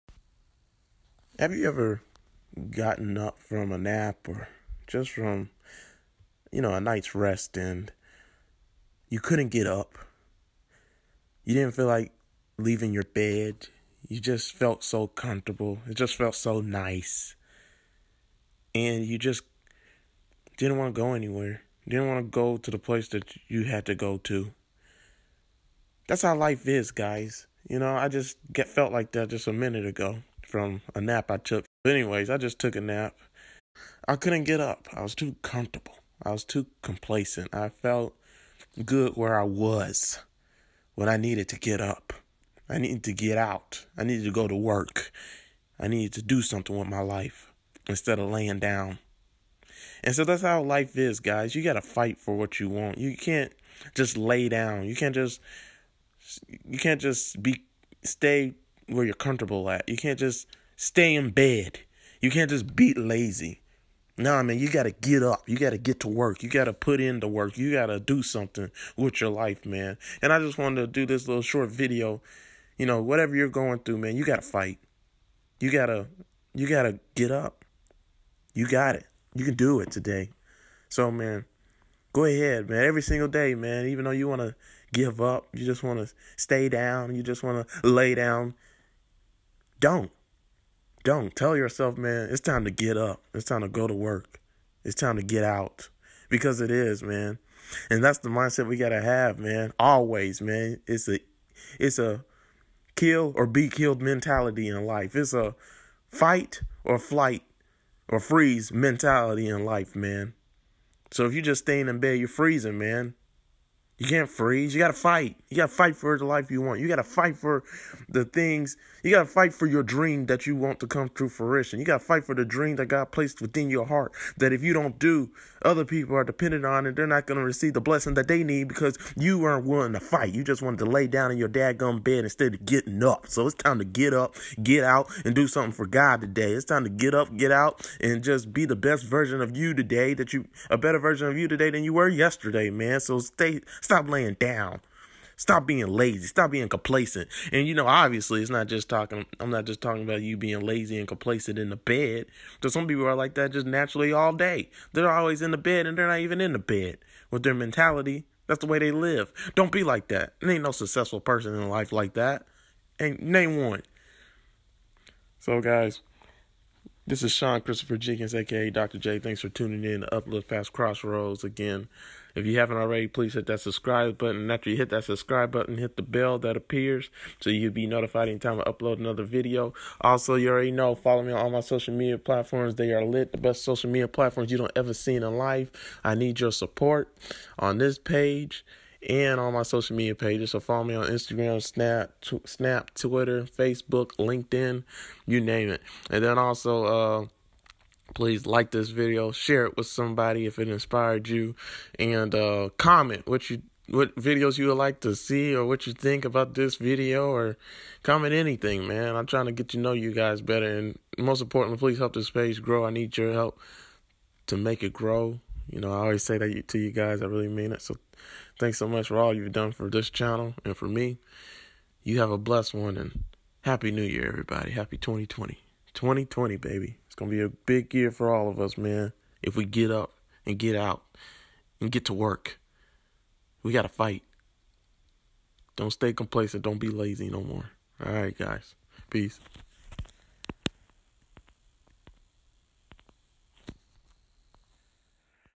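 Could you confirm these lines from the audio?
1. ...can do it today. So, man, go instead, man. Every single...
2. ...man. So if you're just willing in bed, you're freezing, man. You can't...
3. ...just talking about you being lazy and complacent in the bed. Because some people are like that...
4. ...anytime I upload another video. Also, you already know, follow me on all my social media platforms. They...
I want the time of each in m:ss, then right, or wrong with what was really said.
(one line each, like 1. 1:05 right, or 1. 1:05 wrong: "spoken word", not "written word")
1. 1:19 wrong: "ahead", not "instead"
2. 1:49 wrong: "staying", not "willing"
3. 2:29 right
4. 2:58 right.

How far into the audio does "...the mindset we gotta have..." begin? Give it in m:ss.
1:38.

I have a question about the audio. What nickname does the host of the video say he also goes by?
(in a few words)
Dr. J.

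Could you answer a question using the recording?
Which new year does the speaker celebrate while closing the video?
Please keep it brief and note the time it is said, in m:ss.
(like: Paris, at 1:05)
2020, at 3:44.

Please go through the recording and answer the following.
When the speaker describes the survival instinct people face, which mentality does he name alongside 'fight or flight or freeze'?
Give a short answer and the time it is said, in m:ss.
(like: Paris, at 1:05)
kill or be killed, at 1:42.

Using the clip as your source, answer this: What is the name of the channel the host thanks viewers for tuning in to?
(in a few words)
Uplift Past Crossroads.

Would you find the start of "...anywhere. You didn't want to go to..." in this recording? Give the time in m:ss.
0:21.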